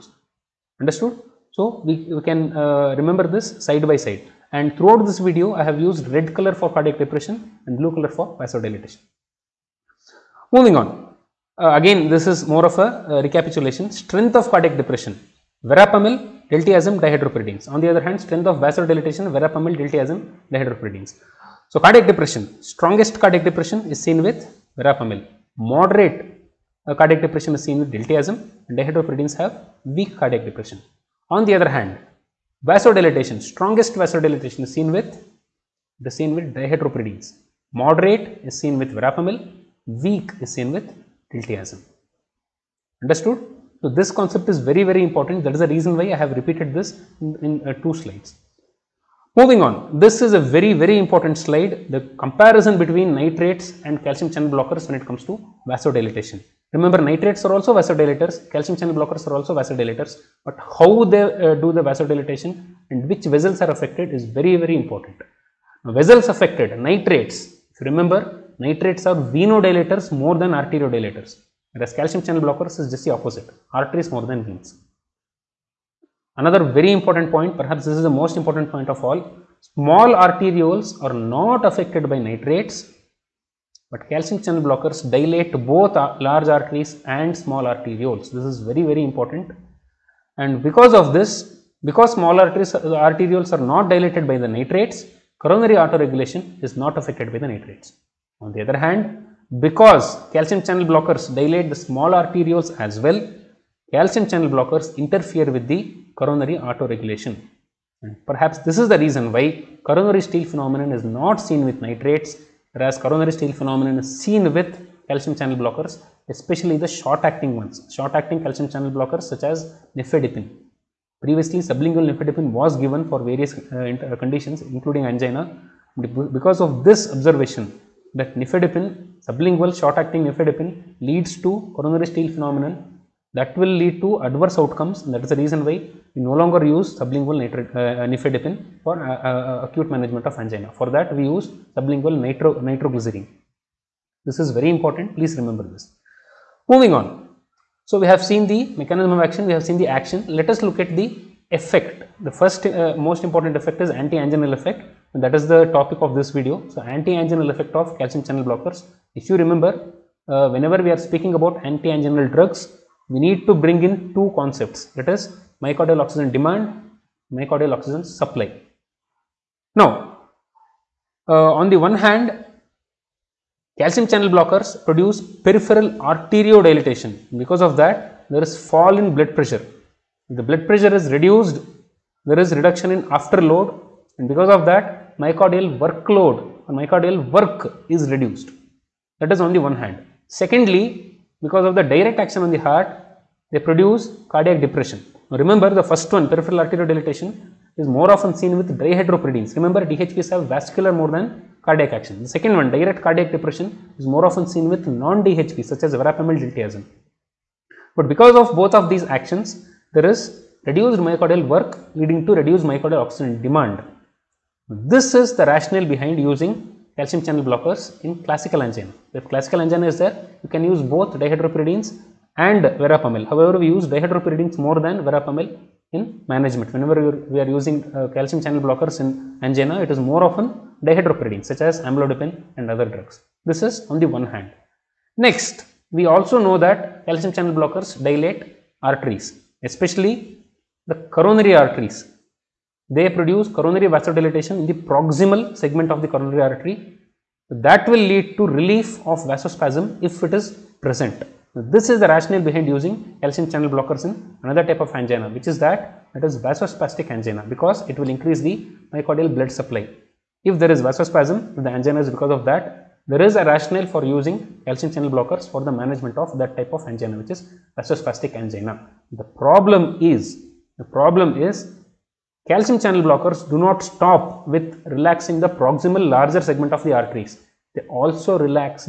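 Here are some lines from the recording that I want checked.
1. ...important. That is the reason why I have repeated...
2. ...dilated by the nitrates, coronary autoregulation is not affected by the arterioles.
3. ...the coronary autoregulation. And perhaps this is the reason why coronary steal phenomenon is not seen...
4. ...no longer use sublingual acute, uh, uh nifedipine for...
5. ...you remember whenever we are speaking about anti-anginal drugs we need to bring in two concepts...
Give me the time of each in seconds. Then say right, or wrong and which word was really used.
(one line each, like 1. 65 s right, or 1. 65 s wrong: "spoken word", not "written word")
1. 45 s right
2. 93 s wrong: "nitrates", not "arterioles"
3. 105 s right
4. 136 s wrong: "nitrate", not "acute"
5. 159 s right.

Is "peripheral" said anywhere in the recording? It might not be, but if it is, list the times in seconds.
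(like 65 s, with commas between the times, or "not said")
175 s, 196 s.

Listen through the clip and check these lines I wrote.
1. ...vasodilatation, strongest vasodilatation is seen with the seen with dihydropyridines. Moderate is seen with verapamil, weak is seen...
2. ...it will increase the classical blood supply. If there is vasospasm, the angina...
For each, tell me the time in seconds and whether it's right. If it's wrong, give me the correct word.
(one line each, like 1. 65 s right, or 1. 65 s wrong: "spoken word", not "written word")
1. 32 s right
2. 257 s wrong: "myocardial", not "classical".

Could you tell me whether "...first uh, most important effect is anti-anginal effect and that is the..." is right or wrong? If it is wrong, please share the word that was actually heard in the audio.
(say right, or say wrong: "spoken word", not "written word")
right.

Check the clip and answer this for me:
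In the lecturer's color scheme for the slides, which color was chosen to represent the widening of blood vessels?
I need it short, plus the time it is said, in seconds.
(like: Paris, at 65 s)
Blue, at 7 s.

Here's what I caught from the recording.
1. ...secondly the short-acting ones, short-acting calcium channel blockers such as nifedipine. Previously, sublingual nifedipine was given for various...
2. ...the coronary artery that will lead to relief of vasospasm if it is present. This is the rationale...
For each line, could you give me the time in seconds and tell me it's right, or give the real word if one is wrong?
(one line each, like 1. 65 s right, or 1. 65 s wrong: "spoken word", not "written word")
1. 116 s wrong: "especially", not "secondly"
2. 246 s right.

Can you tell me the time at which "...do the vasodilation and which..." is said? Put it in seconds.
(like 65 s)
61 s.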